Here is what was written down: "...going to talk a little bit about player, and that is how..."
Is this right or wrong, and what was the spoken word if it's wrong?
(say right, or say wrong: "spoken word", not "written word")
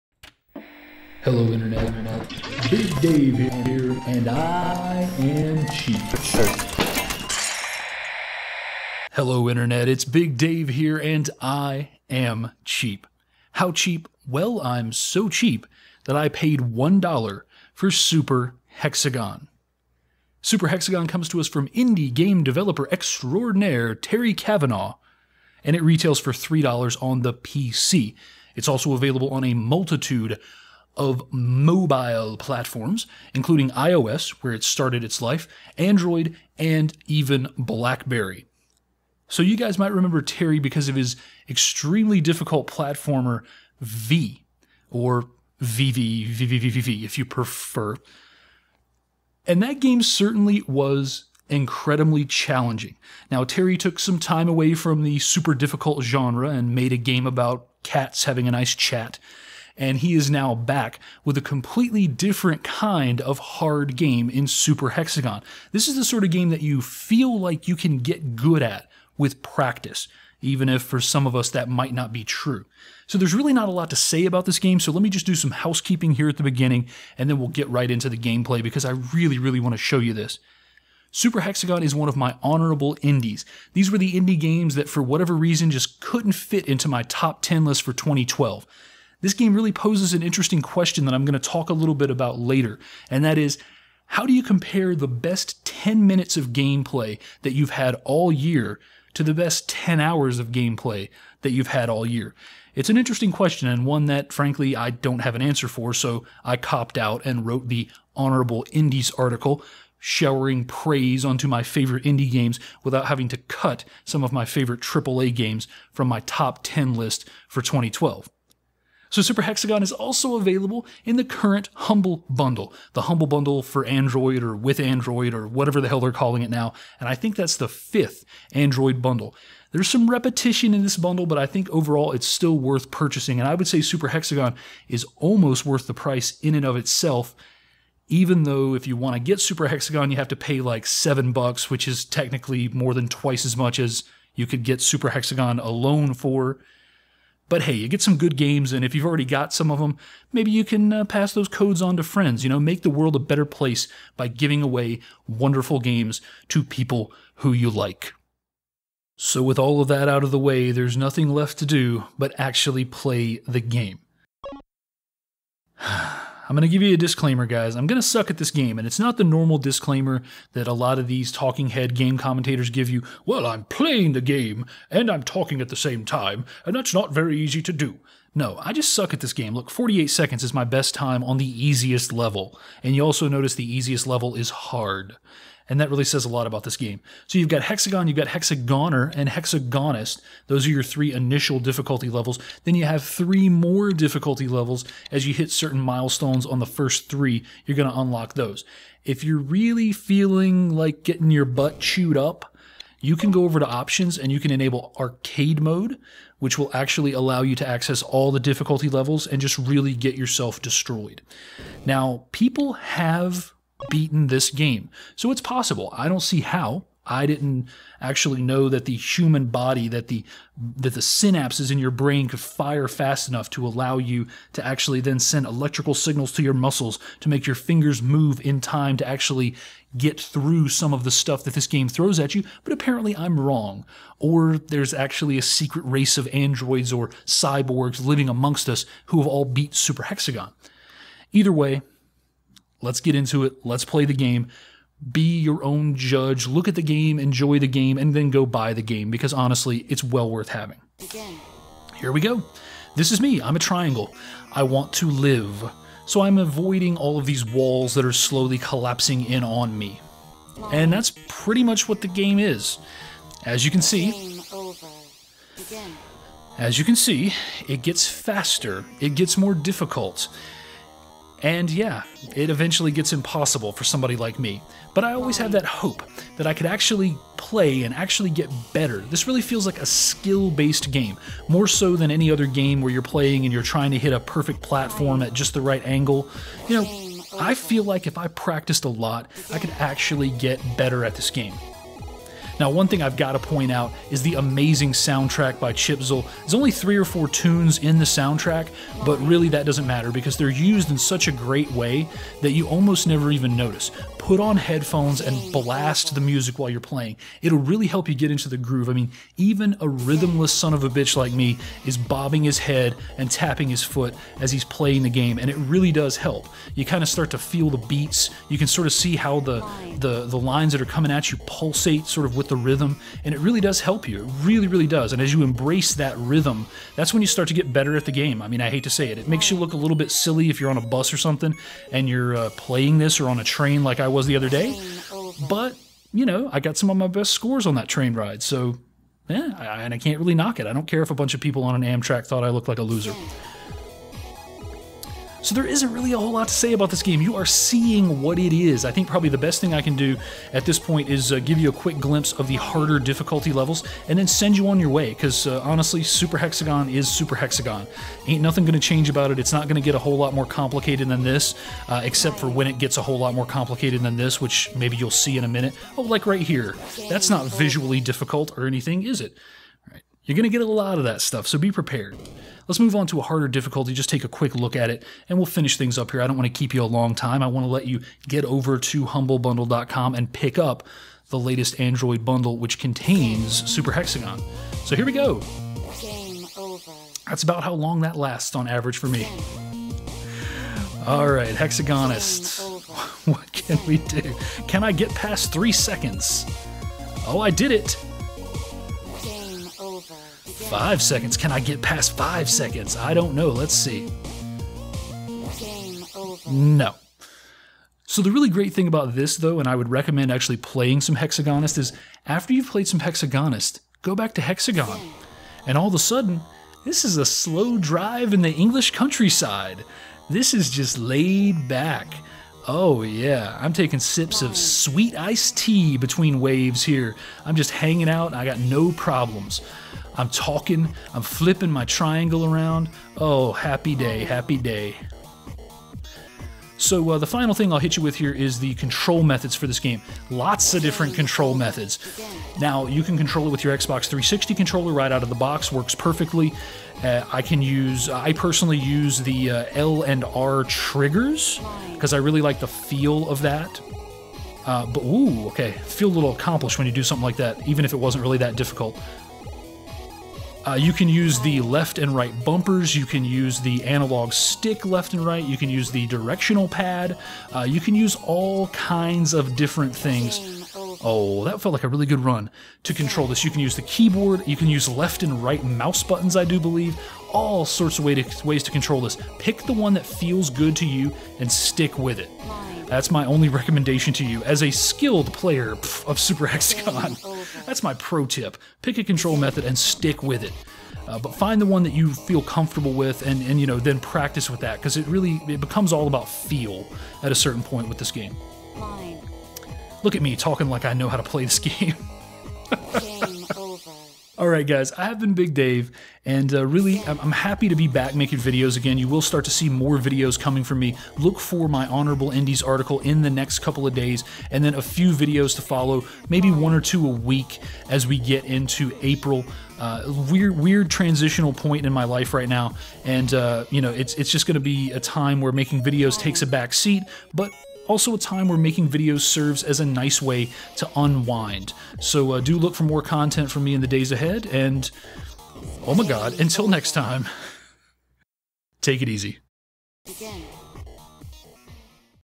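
wrong: "later", not "player".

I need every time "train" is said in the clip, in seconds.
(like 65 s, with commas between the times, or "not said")
333 s, 337 s.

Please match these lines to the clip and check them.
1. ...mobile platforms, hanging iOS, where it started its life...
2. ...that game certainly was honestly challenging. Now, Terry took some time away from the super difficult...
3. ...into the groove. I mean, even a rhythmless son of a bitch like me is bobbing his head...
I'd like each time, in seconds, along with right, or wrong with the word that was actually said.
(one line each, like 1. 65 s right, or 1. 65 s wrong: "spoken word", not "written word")
1. 31 s wrong: "including", not "hanging"
2. 49 s wrong: "incredibly", not "honestly"
3. 308 s right.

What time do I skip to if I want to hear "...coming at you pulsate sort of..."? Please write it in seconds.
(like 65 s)
320 s.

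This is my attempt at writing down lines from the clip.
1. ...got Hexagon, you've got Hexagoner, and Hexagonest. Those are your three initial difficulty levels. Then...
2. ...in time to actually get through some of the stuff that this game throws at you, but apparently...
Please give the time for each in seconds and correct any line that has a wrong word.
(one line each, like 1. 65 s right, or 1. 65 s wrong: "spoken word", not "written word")
1. 187 s right
2. 228 s right.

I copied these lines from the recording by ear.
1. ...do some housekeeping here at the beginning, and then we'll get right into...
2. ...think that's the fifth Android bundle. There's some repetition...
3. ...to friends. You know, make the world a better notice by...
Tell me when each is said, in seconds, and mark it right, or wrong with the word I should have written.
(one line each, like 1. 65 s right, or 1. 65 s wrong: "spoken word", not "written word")
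1. 75 s right
2. 127 s right
3. 151 s wrong: "place", not "notice".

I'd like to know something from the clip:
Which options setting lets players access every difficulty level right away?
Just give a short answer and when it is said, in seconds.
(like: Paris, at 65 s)
arcade mode, at 204 s.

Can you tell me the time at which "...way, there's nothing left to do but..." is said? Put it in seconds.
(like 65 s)
160 s.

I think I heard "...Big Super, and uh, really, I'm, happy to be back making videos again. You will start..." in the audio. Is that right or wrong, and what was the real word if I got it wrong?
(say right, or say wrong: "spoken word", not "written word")
wrong: "Dave", not "Super".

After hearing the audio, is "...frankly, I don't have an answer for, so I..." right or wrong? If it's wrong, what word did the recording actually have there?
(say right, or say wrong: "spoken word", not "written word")
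right.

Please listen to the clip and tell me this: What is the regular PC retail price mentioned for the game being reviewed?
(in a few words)
$3.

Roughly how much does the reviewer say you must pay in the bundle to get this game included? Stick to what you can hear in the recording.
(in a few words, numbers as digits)
$7.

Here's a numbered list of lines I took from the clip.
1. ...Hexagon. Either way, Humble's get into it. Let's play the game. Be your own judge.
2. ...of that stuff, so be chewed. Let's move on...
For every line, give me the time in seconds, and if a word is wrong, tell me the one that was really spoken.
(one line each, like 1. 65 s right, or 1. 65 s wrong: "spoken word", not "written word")
1. 240 s wrong: "Let", not "Humble"
2. 370 s wrong: "prepared", not "chewed".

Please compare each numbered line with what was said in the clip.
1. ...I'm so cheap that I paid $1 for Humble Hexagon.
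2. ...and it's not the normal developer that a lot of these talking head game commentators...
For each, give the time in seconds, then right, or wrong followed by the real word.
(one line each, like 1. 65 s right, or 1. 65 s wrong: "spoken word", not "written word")
1. 14 s wrong: "Super", not "Humble"
2. 168 s wrong: "disclaimer", not "developer".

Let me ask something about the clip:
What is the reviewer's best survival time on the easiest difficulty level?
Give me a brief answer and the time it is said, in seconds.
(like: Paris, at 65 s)
48 seconds, at 179 s.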